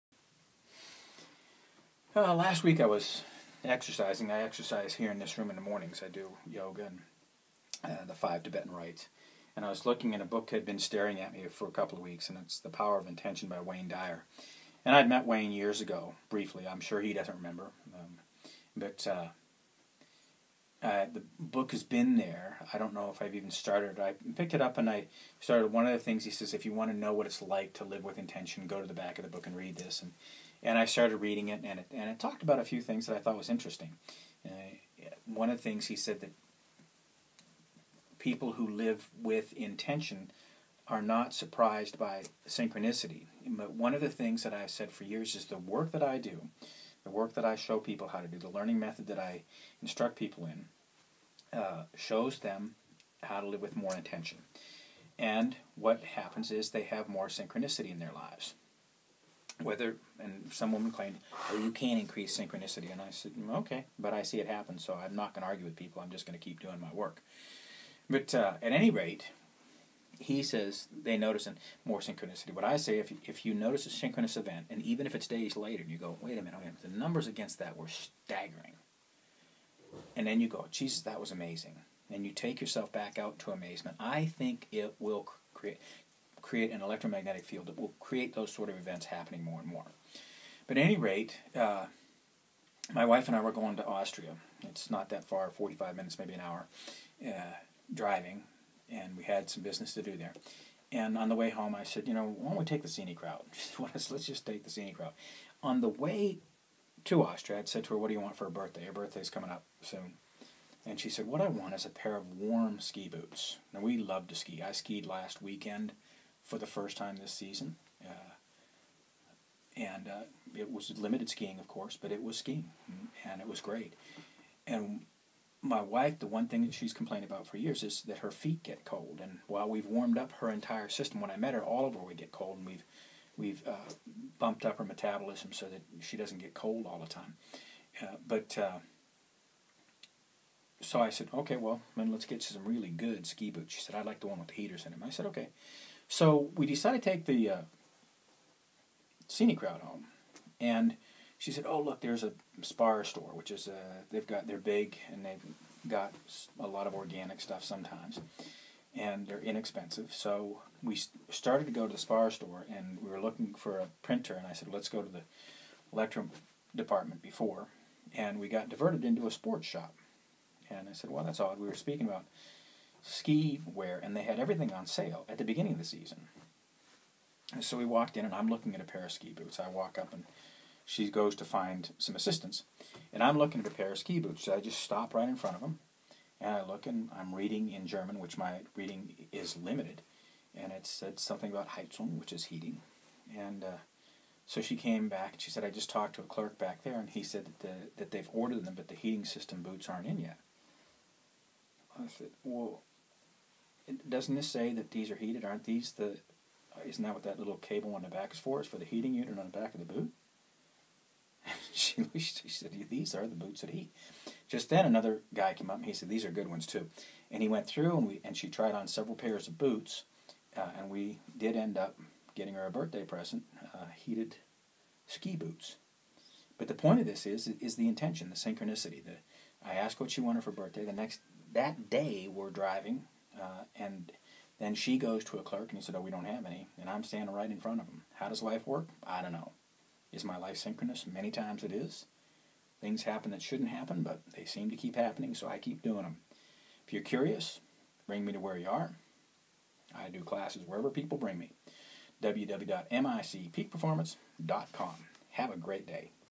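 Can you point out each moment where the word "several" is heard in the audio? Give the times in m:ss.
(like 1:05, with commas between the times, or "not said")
3:38.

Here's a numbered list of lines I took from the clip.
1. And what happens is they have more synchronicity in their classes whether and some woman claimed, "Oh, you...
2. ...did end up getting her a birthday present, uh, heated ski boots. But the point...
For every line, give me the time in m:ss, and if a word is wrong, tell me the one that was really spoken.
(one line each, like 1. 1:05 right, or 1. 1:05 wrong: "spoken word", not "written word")
1. 0:55 wrong: "lives", not "classes"
2. 3:41 right.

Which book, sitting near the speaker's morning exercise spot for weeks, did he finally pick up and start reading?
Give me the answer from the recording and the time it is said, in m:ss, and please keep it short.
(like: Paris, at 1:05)
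The Power of Intention, at 0:12.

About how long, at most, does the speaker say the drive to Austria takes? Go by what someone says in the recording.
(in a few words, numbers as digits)
An hour.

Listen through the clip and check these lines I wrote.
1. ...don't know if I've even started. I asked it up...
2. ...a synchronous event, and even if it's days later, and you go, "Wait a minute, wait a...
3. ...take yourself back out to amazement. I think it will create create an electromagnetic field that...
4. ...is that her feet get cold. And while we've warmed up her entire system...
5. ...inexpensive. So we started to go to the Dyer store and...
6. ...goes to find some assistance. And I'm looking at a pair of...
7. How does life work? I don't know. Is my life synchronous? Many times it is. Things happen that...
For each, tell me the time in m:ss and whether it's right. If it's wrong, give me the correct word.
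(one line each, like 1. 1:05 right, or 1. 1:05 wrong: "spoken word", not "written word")
1. 0:22 wrong: "picked", not "asked"
2. 1:13 right
3. 1:22 right
4. 2:07 right
5. 2:39 wrong: "Spar", not "Dyer"
6. 3:01 right
7. 3:58 right.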